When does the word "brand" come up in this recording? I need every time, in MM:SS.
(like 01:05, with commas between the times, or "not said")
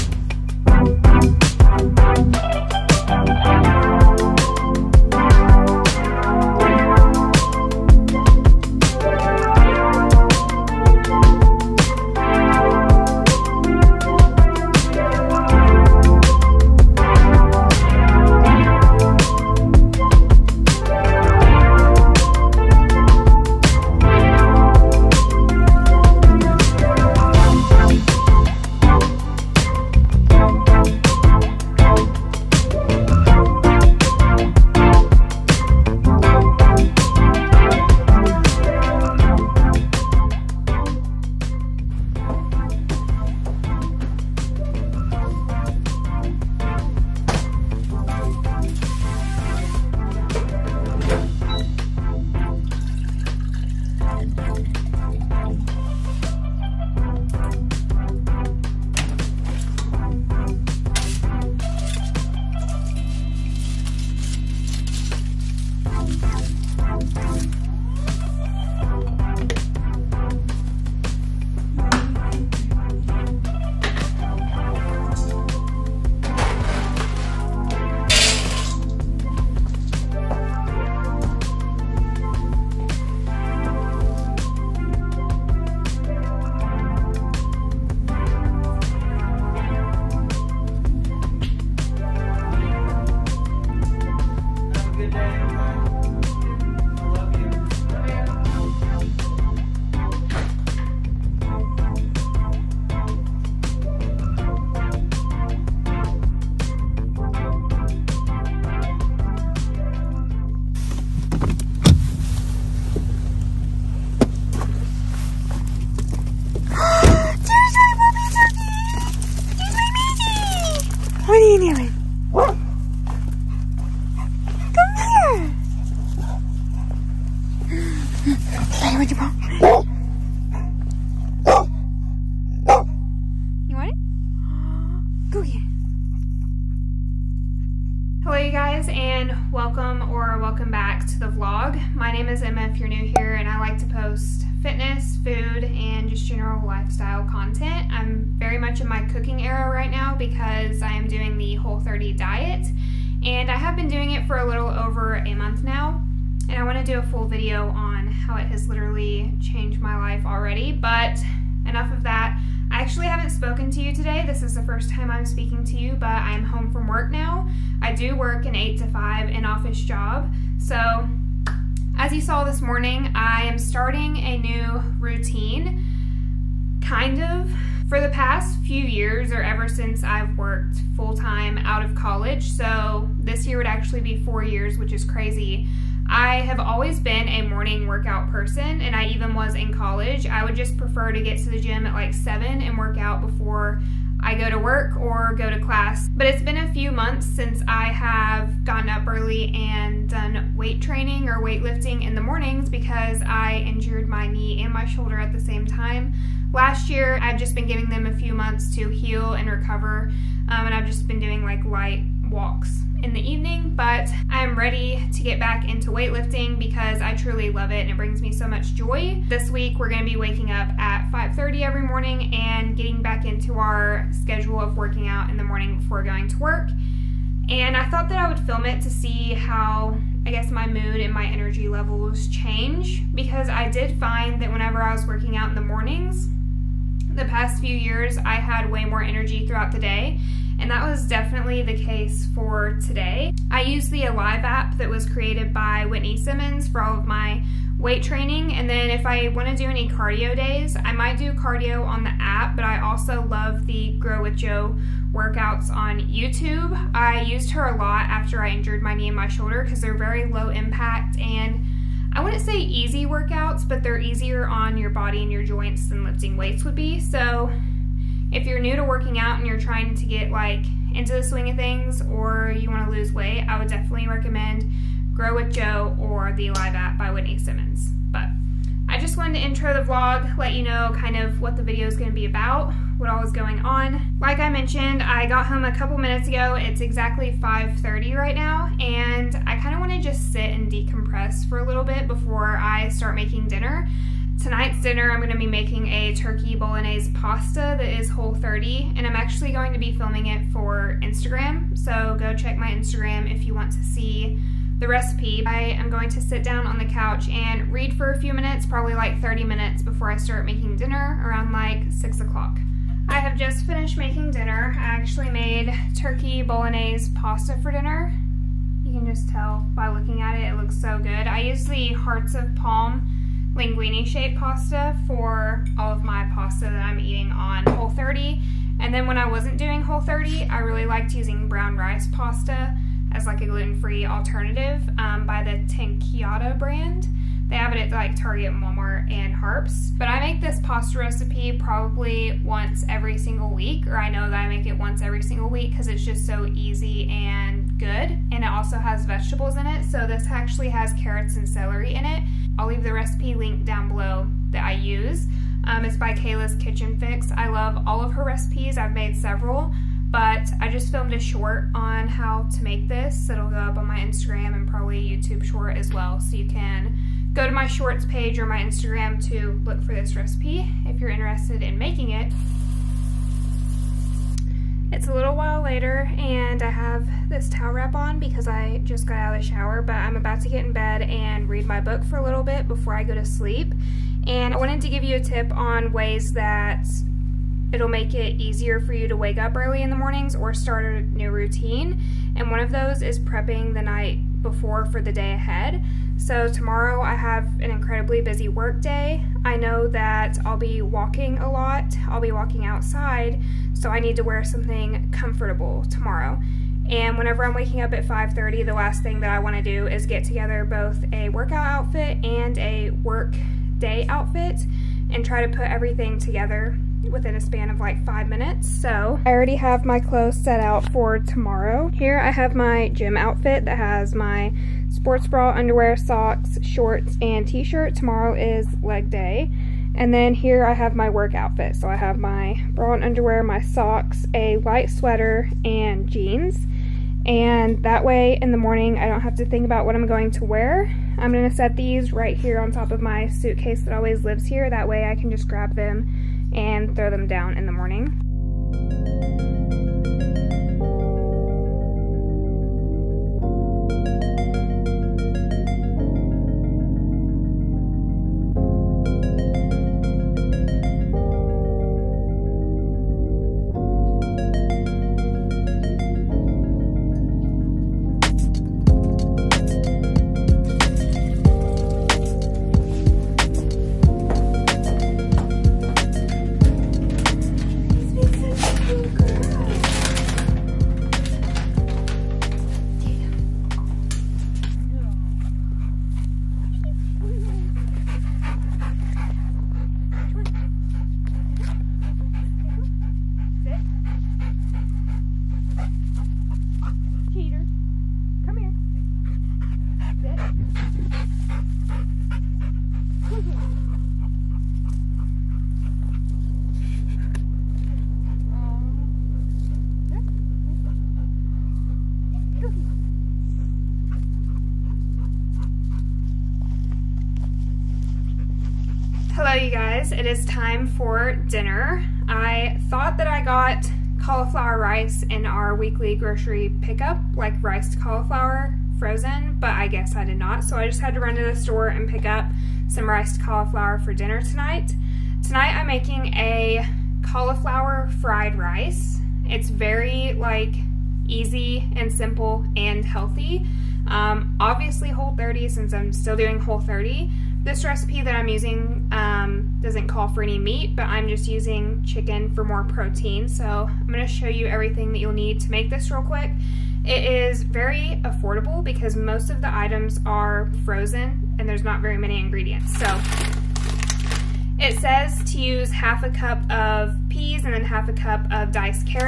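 05:36.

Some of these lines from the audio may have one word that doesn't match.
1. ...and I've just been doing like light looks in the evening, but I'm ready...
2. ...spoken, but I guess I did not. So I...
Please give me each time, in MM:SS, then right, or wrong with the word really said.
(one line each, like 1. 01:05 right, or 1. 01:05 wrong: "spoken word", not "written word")
1. 03:30 wrong: "walks", not "looks"
2. 08:48 wrong: "frozen", not "spoken".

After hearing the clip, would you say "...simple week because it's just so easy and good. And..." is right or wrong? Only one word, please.
wrong.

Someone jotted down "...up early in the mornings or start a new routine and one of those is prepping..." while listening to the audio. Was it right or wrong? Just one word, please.
right.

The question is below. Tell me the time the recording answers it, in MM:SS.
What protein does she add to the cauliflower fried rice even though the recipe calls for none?
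09:12.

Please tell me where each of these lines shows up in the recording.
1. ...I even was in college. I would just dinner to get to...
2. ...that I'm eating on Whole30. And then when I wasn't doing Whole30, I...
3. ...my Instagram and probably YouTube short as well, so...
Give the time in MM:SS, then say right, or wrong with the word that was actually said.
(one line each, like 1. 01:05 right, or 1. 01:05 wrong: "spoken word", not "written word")
1. 03:08 wrong: "prefer", not "dinner"
2. 05:26 right
3. 06:03 right.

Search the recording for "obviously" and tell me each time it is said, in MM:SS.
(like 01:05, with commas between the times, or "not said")
09:04.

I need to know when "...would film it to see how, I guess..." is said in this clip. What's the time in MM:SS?
03:48.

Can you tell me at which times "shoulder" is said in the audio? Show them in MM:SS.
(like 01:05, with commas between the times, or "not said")
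03:24, 04:19.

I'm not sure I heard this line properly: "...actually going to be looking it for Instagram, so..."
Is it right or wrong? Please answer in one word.
wrong.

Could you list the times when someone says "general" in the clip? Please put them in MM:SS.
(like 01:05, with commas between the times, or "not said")
02:26.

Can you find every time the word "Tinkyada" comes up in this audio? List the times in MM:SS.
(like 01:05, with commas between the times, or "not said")
05:35.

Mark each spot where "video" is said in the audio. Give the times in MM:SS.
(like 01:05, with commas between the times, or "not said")
02:37, 04:41.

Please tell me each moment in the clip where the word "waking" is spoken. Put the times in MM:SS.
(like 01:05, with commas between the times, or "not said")
03:40, 06:47.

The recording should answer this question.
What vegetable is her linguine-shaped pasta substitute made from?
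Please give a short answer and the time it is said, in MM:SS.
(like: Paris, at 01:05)
hearts of palm, at 05:21.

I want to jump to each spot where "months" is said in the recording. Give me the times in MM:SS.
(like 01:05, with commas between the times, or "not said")
02:35, 03:16, 03:28.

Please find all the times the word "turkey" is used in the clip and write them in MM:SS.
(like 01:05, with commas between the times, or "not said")
04:56, 05:15.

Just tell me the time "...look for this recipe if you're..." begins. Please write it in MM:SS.
06:09.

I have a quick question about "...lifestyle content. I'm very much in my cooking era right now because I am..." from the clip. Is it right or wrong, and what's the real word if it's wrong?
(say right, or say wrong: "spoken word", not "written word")
right.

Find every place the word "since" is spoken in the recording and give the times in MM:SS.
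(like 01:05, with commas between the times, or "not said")
02:59, 03:17, 09:05.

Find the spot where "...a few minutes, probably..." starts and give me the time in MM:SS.
05:08.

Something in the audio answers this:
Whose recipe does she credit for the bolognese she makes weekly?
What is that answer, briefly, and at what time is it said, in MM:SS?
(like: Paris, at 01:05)
Kayla's Kitchen Fix, at 05:56.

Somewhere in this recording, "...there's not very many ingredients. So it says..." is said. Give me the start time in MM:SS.
09:21.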